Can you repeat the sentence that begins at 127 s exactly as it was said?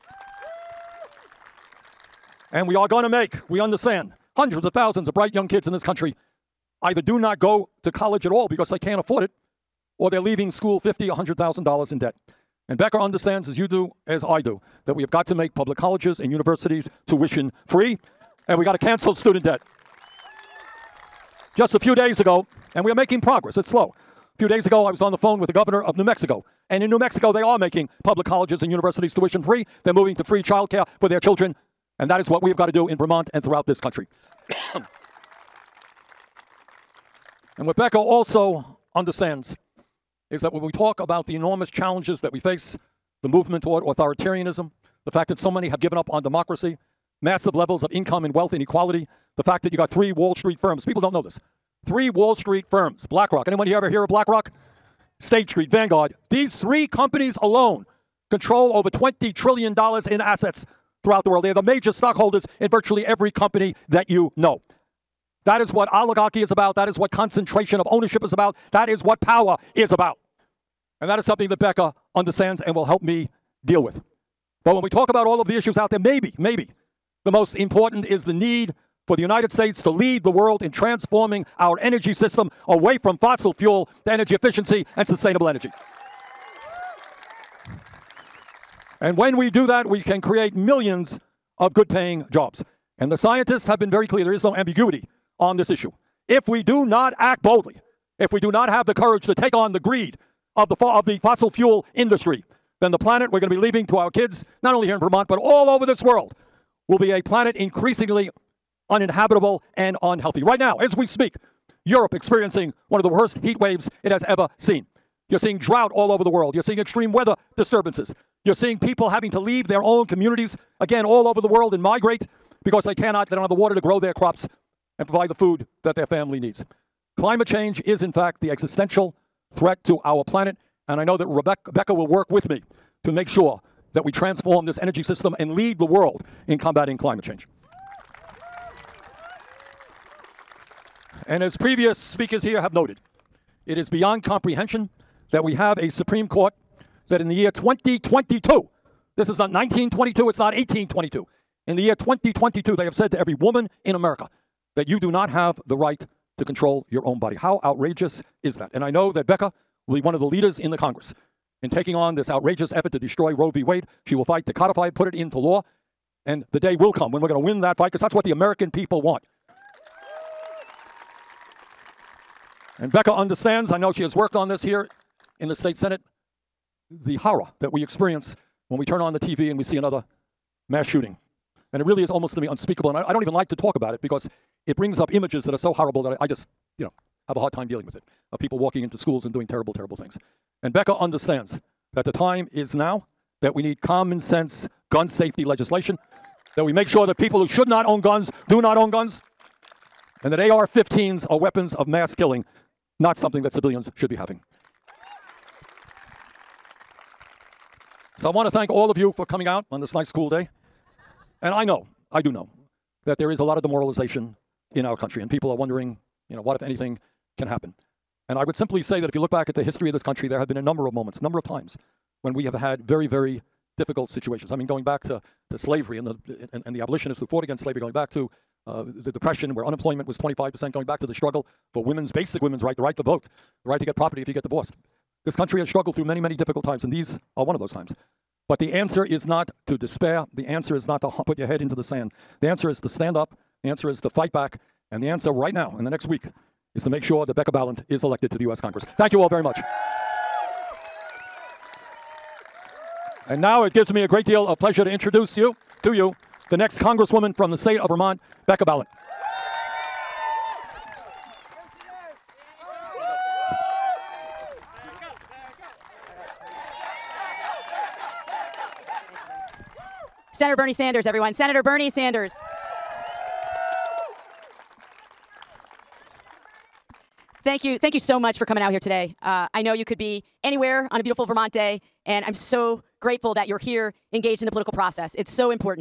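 Climate change is, in fact, the existential threat to our planet.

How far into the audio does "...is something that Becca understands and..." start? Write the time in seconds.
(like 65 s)
71 s.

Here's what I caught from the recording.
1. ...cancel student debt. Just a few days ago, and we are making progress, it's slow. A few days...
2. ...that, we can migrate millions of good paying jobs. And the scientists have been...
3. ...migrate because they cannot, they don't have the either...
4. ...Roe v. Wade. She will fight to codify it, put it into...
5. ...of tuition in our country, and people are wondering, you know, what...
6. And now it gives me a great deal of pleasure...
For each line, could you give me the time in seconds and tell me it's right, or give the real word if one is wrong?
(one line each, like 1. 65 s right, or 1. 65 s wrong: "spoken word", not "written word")
1. 18 s right
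2. 89 s wrong: "create", not "migrate"
3. 121 s wrong: "water", not "either"
4. 163 s right
5. 213 s wrong: "demoralization", not "tuition"
6. 253 s right.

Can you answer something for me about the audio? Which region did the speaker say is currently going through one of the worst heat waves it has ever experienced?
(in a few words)
Europe.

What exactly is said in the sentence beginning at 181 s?
And it really is almost to me unspeakable.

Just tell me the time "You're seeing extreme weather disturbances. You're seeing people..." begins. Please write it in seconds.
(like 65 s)
116 s.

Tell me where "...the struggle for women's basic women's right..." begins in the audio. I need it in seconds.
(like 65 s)
231 s.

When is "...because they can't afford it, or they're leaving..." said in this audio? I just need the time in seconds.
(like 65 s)
8 s.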